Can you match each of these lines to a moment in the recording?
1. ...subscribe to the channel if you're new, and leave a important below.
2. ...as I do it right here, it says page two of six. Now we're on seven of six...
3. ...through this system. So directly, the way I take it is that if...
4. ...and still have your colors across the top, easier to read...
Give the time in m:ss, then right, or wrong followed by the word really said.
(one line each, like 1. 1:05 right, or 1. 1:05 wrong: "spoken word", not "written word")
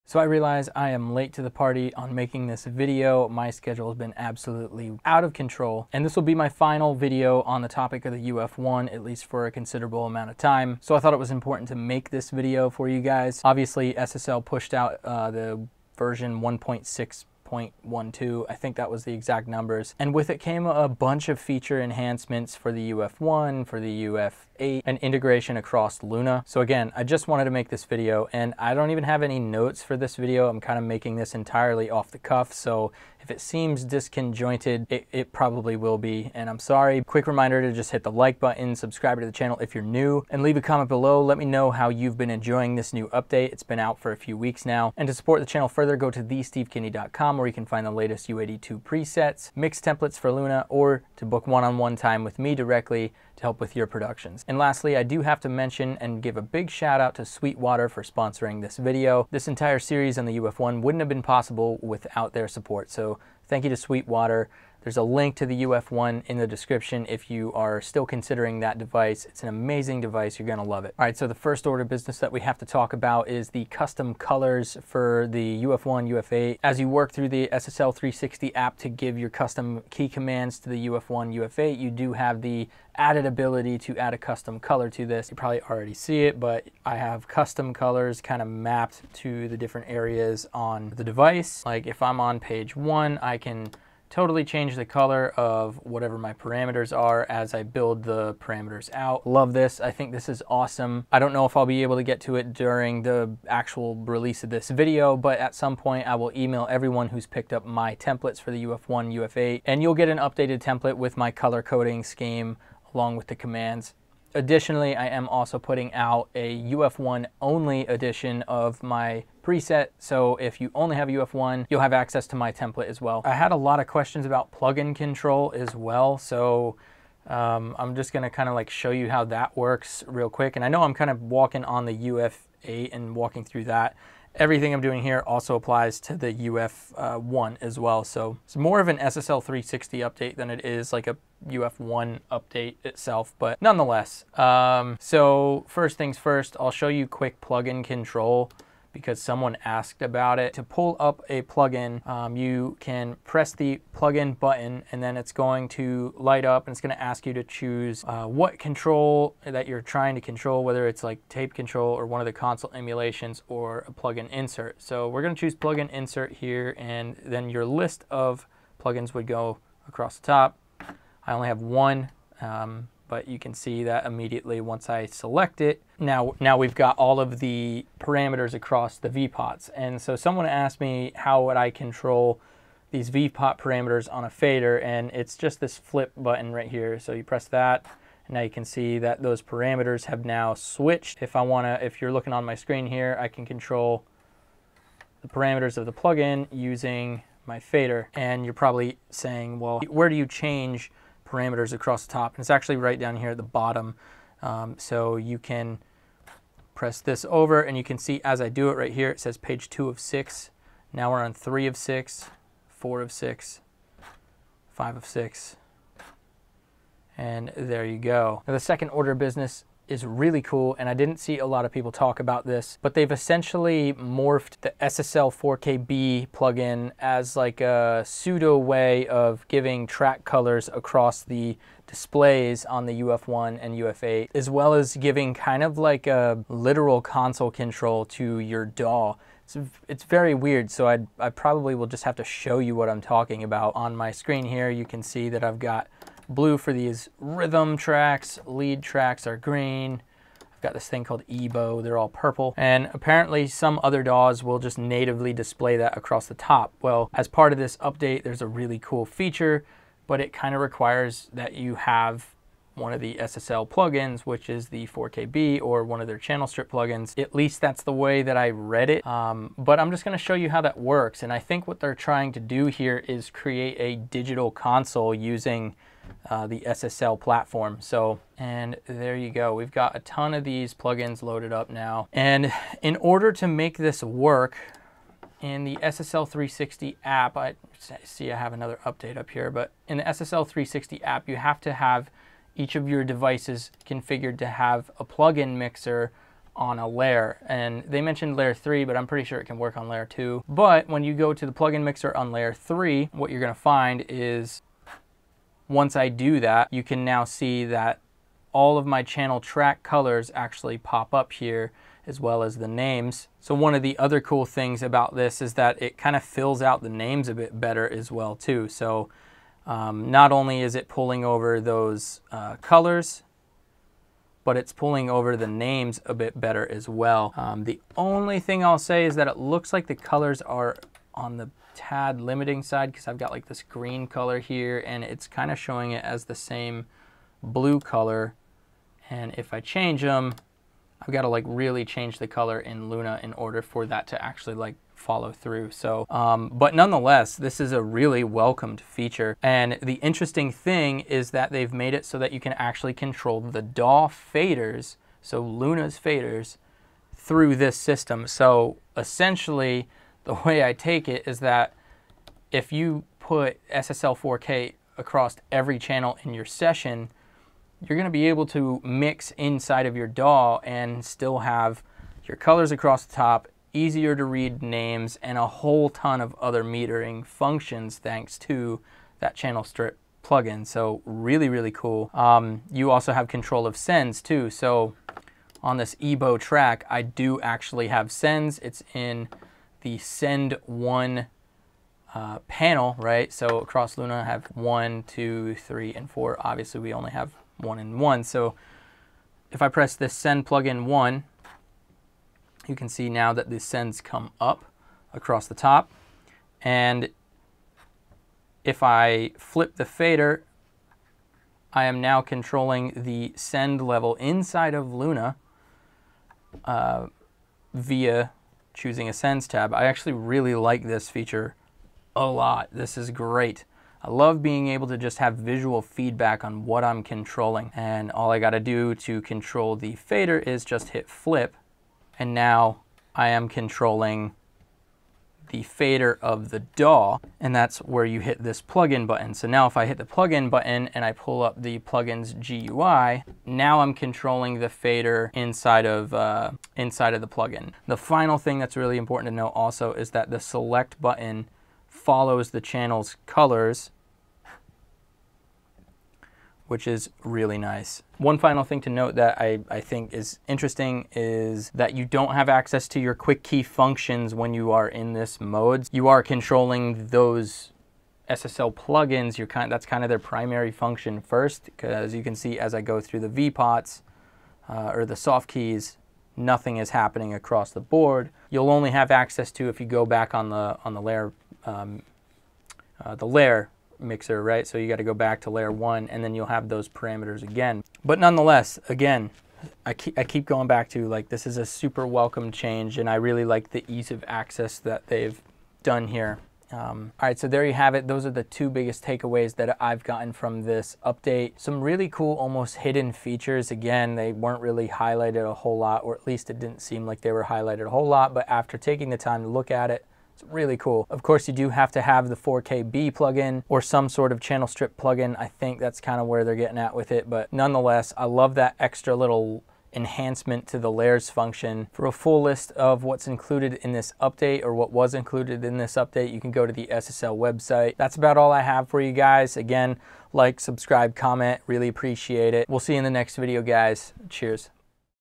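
1. 0:38 wrong: "comment", not "important"
2. 3:28 wrong: "three", not "seven"
3. 5:57 wrong: "essentially", not "directly"
4. 6:10 right.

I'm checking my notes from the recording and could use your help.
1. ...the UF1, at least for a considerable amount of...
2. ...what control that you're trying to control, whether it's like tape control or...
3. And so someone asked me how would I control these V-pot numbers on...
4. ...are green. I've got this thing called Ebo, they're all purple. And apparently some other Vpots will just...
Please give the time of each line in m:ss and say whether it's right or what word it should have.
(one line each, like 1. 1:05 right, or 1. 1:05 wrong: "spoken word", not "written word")
1. 0:08 right
2. 2:38 right
3. 2:59 wrong: "parameters", not "numbers"
4. 4:09 wrong: "DAWs", not "Vpots".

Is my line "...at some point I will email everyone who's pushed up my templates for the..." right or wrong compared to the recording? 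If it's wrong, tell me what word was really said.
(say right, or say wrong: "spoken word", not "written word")
wrong: "picked", not "pushed".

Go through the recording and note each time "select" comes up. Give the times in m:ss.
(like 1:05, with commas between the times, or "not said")
2:55, 7:30.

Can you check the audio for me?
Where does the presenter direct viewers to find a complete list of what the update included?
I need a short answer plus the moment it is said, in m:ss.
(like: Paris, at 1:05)
SSL website, at 8:46.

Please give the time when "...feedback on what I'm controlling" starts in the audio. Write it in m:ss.
7:05.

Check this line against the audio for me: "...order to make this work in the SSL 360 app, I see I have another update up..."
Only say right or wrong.
right.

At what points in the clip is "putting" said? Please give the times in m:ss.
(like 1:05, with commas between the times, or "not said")
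1:55.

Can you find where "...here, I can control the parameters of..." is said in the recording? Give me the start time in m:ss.
3:12.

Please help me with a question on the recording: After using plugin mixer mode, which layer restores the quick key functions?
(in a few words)
layer 1.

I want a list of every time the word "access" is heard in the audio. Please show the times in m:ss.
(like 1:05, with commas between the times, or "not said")
2:01, 7:42, 7:59, 8:14.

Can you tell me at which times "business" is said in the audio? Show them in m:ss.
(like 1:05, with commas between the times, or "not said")
1:11, 3:39.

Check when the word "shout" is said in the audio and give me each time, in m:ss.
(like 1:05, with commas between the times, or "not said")
0:56.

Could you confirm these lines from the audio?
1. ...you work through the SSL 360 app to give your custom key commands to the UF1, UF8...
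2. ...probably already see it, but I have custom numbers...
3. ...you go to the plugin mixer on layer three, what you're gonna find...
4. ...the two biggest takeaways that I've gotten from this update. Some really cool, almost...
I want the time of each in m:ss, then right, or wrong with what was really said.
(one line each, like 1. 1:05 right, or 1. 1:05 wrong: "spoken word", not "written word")
1. 1:16 right
2. 1:25 wrong: "colors", not "numbers"
3. 5:01 right
4. 8:18 right.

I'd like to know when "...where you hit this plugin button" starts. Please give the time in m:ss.
7:17.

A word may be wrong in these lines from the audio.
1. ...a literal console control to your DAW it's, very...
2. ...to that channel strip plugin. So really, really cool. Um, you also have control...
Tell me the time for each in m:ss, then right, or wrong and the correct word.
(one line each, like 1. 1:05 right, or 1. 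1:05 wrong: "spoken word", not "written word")
1. 3:56 right
2. 6:18 right.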